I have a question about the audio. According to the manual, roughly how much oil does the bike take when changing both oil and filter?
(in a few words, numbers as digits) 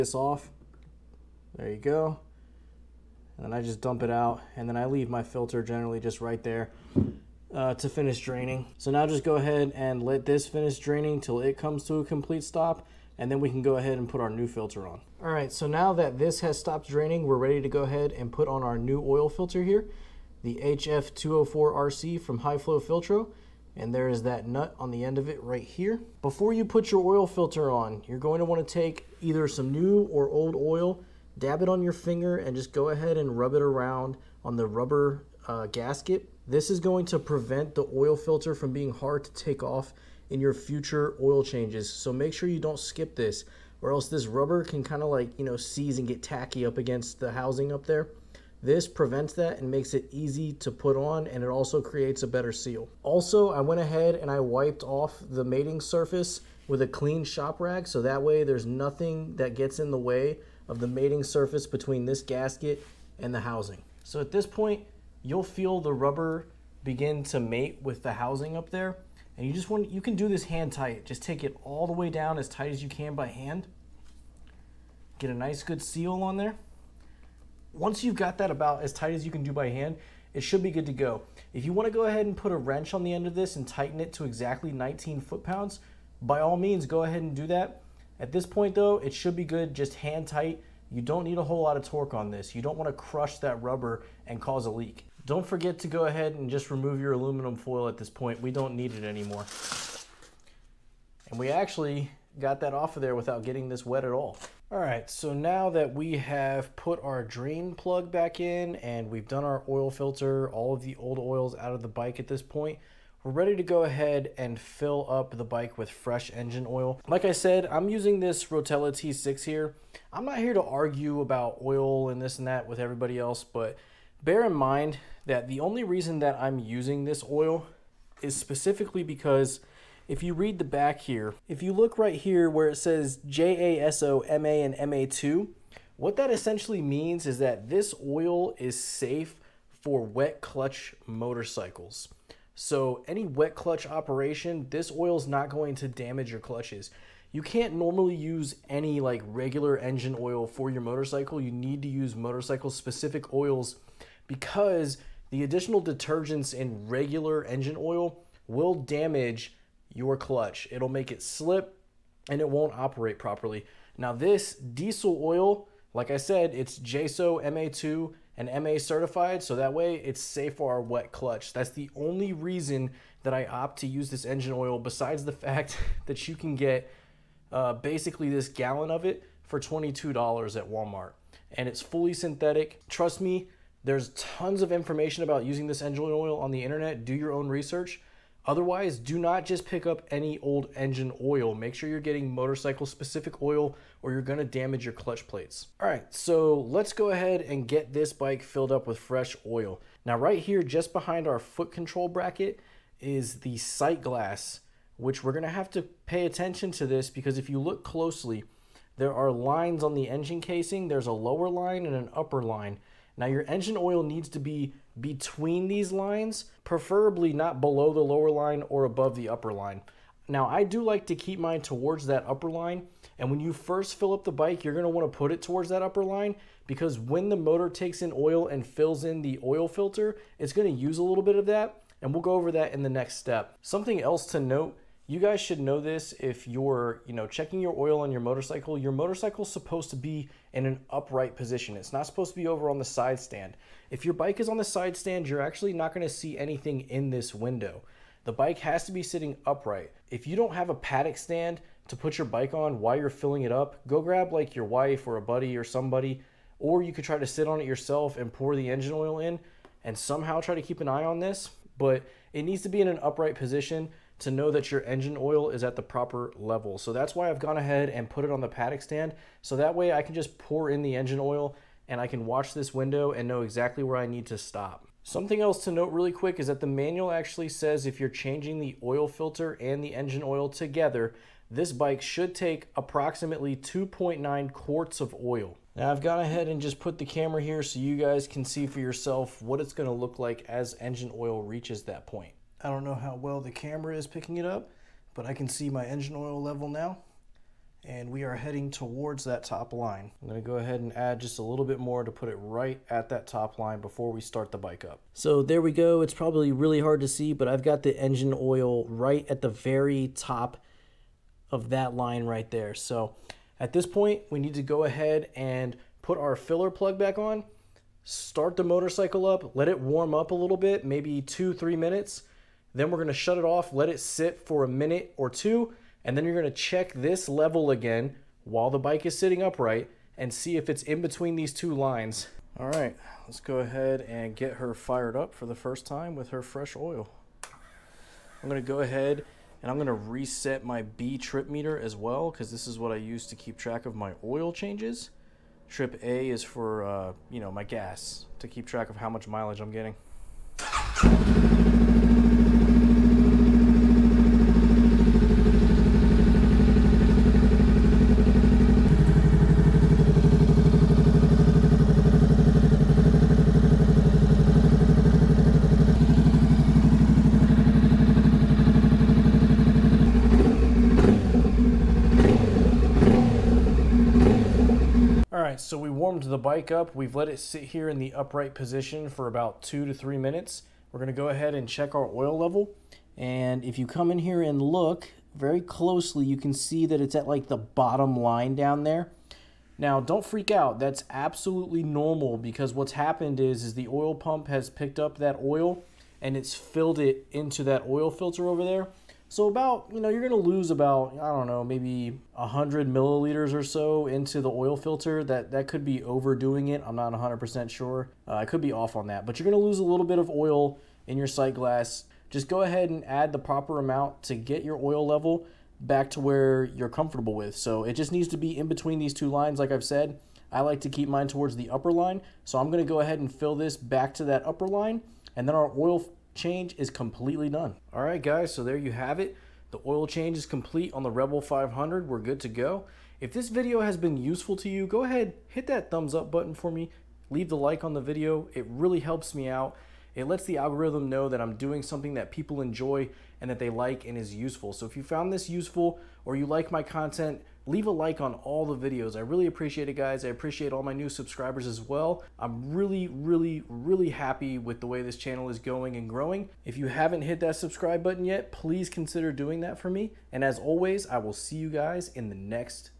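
2.9 quarts.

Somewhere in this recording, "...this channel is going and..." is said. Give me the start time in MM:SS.
07:35.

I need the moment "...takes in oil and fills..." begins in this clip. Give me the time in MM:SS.
03:47.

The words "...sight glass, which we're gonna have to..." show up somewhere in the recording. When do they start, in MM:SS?
03:23.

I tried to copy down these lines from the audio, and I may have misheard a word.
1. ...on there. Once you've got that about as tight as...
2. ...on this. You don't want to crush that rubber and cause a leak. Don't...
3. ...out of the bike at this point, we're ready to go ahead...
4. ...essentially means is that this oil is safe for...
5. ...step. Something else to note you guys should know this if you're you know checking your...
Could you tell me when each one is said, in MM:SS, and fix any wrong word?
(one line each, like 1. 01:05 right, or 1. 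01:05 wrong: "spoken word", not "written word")
1. 01:16 right
2. 01:32 right
3. 01:51 right
4. 02:16 right
5. 03:53 right.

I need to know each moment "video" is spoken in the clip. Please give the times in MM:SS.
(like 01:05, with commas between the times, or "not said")
07:13, 07:17, 07:28.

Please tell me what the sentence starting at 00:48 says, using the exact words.
This prevents that and makes it easy to put on and it also creates a better seal.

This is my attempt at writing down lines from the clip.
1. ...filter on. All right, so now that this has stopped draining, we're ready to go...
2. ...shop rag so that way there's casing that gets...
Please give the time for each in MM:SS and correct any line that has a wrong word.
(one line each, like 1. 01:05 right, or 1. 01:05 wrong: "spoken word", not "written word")
1. 00:14 right
2. 00:57 wrong: "nothing", not "casing".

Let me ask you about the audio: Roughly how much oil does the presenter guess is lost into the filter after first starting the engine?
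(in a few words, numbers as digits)
100 milliliters.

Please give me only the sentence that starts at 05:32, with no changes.
All right, let's go ahead and get her fired up for the first time with her fresh oil.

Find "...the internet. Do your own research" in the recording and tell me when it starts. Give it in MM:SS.
03:06.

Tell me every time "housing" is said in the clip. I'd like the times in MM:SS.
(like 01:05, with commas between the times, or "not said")
00:47, 01:03, 01:08.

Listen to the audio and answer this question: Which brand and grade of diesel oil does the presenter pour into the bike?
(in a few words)
Rotella T6.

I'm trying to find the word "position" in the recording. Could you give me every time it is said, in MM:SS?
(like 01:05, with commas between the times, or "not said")
04:01, 04:23, 06:18.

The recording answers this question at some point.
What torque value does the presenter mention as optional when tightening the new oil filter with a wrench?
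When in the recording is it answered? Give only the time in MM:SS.
01:24.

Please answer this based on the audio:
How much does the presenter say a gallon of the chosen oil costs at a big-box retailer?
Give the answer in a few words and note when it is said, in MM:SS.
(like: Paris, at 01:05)
$22, at 02:59.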